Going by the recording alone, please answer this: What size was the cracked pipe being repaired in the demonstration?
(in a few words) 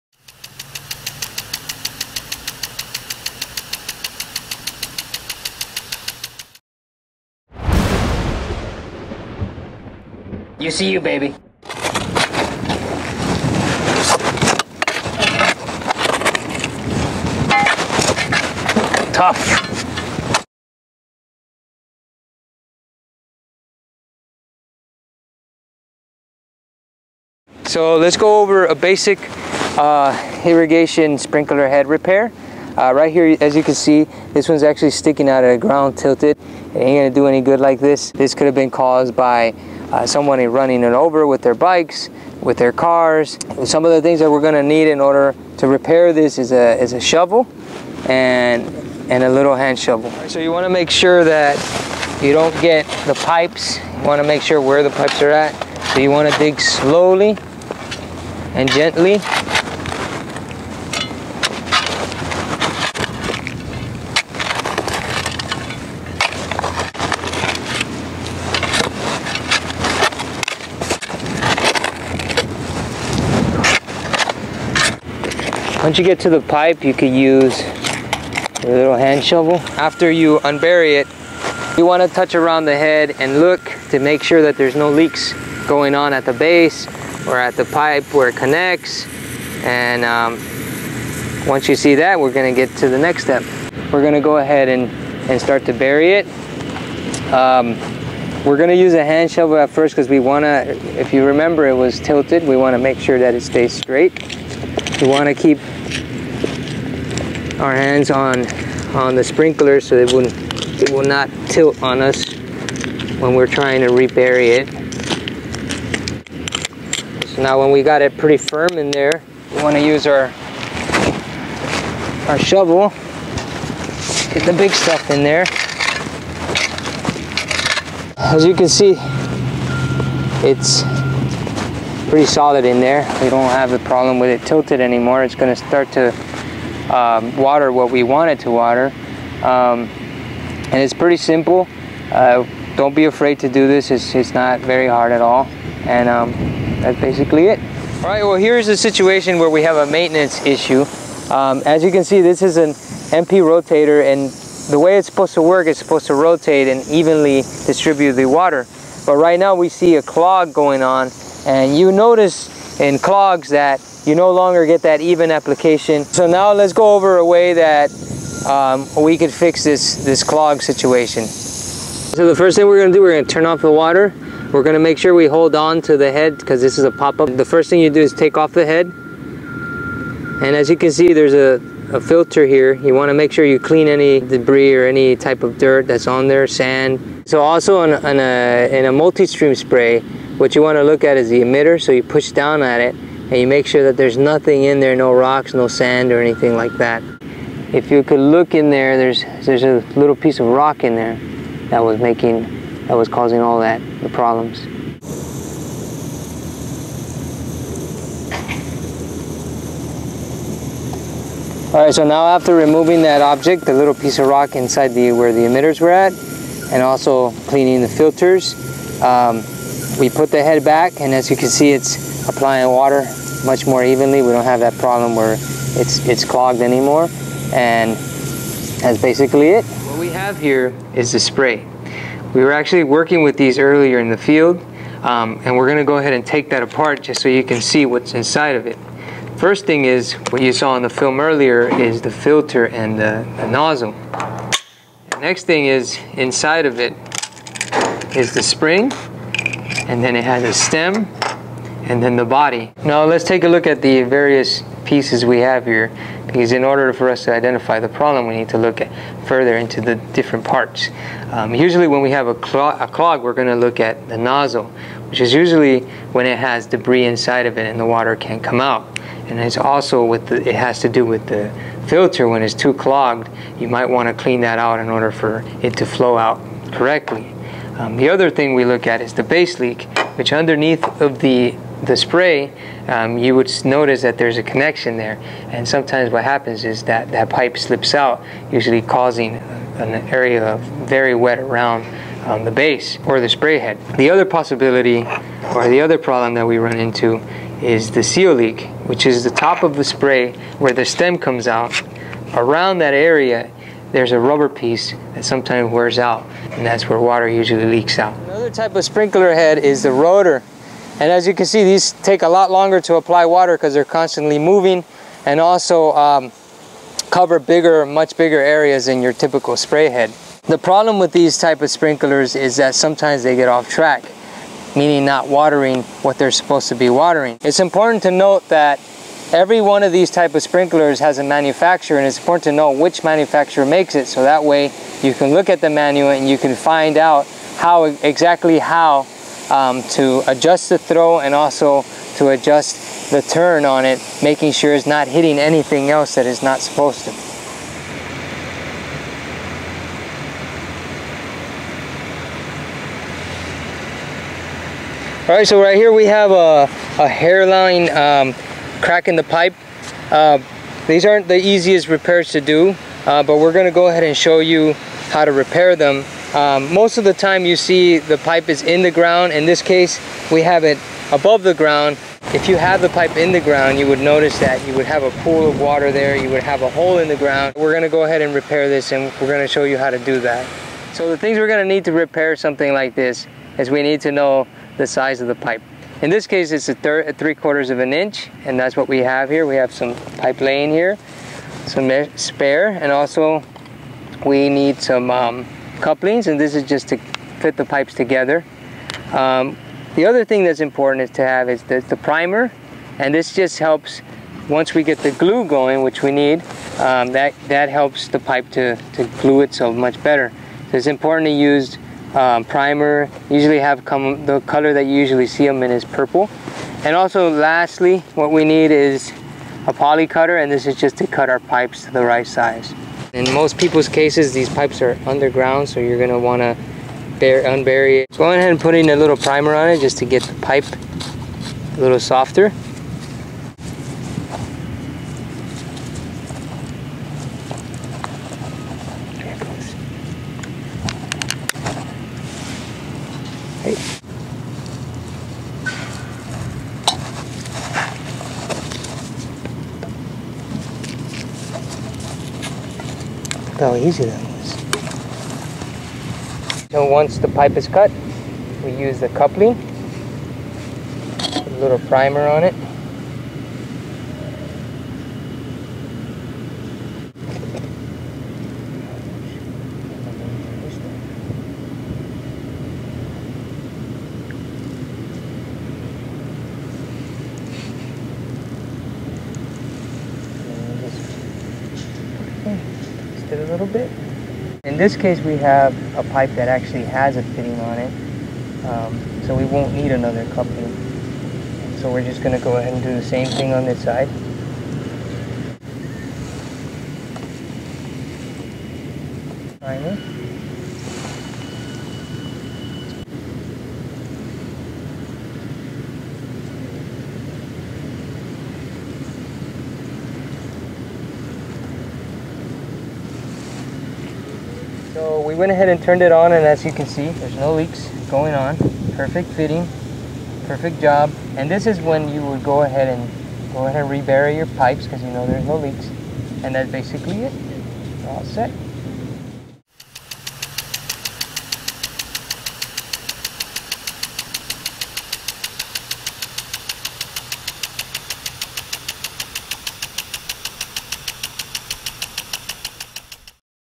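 3/4 inch.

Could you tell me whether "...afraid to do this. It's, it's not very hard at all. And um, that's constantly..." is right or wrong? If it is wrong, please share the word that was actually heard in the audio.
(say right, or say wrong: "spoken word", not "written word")
wrong: "basically", not "constantly".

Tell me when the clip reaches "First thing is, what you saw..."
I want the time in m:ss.
3:59.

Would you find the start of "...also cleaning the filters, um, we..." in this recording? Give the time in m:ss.
3:36.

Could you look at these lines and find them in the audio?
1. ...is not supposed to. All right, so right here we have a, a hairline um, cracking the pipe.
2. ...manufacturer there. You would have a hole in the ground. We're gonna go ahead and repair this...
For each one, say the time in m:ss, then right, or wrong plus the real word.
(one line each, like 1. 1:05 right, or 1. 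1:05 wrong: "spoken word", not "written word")
1. 5:46 right
2. 6:15 wrong: "water", not "manufacturer".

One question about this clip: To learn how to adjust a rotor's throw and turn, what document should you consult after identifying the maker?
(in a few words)
manual.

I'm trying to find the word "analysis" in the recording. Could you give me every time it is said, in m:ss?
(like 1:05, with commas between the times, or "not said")
not said.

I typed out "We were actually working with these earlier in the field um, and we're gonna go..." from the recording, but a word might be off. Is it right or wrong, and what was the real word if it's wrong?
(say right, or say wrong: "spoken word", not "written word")
right.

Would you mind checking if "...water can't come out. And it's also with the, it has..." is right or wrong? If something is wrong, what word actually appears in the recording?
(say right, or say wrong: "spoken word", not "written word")
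right.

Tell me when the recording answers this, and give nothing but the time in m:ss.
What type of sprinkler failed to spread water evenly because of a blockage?
2:33.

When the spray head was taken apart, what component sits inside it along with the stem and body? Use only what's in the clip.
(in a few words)
spring.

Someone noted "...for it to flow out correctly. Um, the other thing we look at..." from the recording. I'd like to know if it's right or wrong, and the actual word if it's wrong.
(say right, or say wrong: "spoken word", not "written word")
right.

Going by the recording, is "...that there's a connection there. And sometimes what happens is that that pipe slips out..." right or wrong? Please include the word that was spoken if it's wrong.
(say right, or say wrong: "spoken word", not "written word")
right.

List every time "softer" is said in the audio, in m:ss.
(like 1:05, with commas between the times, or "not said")
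7:11.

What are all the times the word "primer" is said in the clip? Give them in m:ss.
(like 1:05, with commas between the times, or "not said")
6:41, 6:52, 7:09, 7:41, 8:19.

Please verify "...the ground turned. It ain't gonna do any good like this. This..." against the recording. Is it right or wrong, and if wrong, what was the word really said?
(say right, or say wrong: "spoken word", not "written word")
wrong: "tilted", not "turned".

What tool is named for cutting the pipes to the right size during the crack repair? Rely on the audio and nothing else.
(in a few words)
poly cutter.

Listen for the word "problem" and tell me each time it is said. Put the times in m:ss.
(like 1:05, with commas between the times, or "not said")
2:13, 3:24, 3:44, 4:17, 4:55, 5:20.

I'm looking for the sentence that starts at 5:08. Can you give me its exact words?
Another type of sprinkler head is the rotor.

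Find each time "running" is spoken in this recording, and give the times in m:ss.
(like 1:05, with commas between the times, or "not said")
0:40.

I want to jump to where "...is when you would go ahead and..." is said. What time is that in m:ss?
8:41.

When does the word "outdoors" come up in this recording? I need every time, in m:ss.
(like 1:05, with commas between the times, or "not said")
not said.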